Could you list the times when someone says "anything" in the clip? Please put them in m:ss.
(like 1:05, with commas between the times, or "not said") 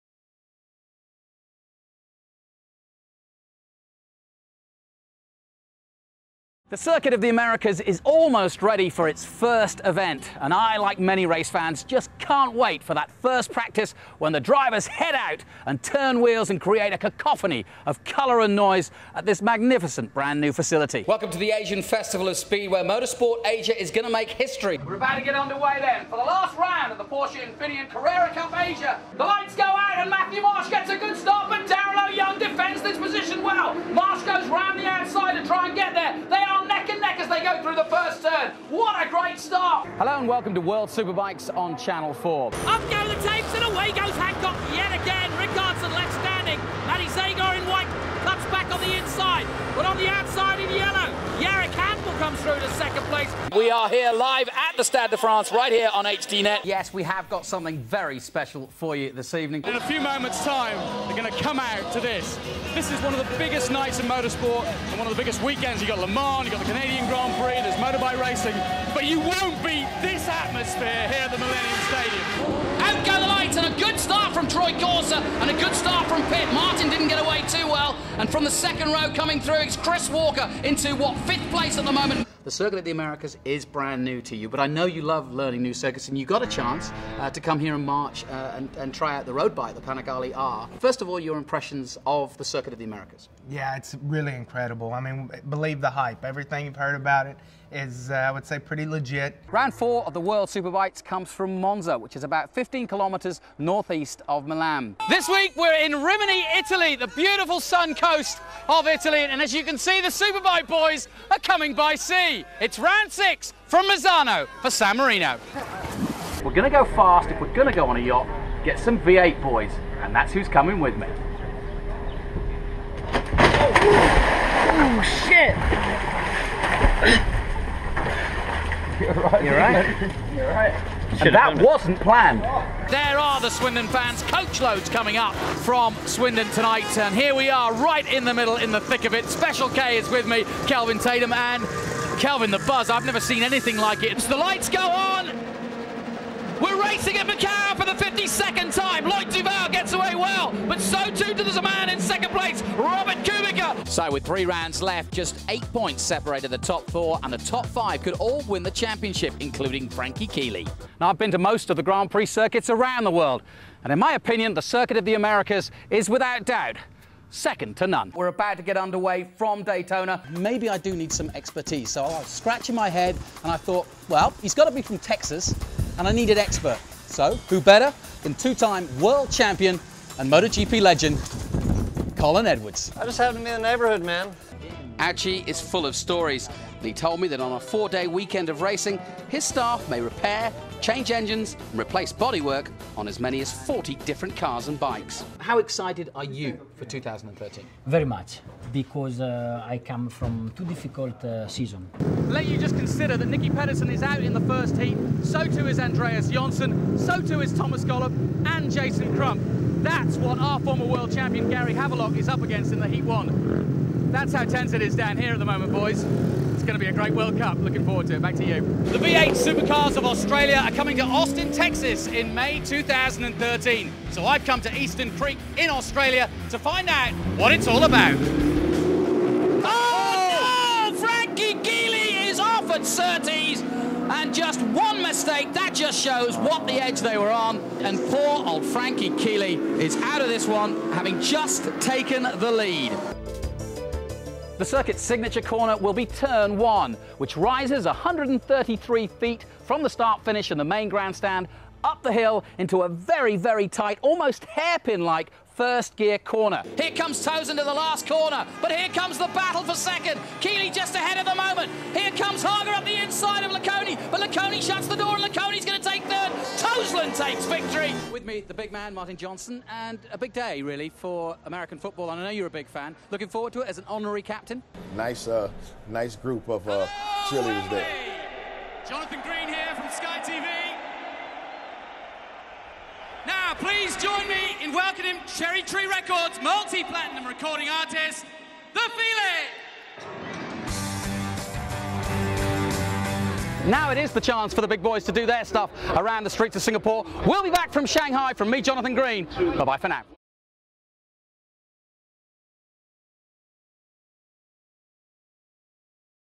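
2:23.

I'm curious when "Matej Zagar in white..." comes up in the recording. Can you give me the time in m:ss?
0:46.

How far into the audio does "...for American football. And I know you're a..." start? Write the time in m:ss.
4:30.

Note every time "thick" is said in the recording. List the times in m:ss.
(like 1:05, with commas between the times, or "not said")
2:18.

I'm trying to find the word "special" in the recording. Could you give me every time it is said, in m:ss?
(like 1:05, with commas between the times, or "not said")
0:58, 2:19.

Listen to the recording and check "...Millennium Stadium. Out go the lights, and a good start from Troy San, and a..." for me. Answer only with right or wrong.
wrong.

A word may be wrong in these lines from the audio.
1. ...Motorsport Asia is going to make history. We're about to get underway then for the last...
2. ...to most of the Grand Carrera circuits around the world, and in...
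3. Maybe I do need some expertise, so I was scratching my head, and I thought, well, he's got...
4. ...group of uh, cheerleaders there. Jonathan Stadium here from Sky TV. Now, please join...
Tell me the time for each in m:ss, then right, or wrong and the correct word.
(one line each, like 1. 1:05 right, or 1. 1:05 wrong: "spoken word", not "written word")
1. 0:22 right
2. 2:41 wrong: "Prix", not "Carrera"
3. 2:50 right
4. 4:36 wrong: "Green", not "Stadium".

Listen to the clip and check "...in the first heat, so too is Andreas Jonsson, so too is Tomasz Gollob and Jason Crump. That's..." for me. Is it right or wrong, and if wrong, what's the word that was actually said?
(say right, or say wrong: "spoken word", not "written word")
right.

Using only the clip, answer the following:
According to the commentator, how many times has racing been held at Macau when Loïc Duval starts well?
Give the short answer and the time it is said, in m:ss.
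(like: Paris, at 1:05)
52, at 2:28.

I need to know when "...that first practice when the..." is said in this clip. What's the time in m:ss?
0:12.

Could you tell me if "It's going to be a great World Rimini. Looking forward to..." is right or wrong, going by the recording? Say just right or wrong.
wrong.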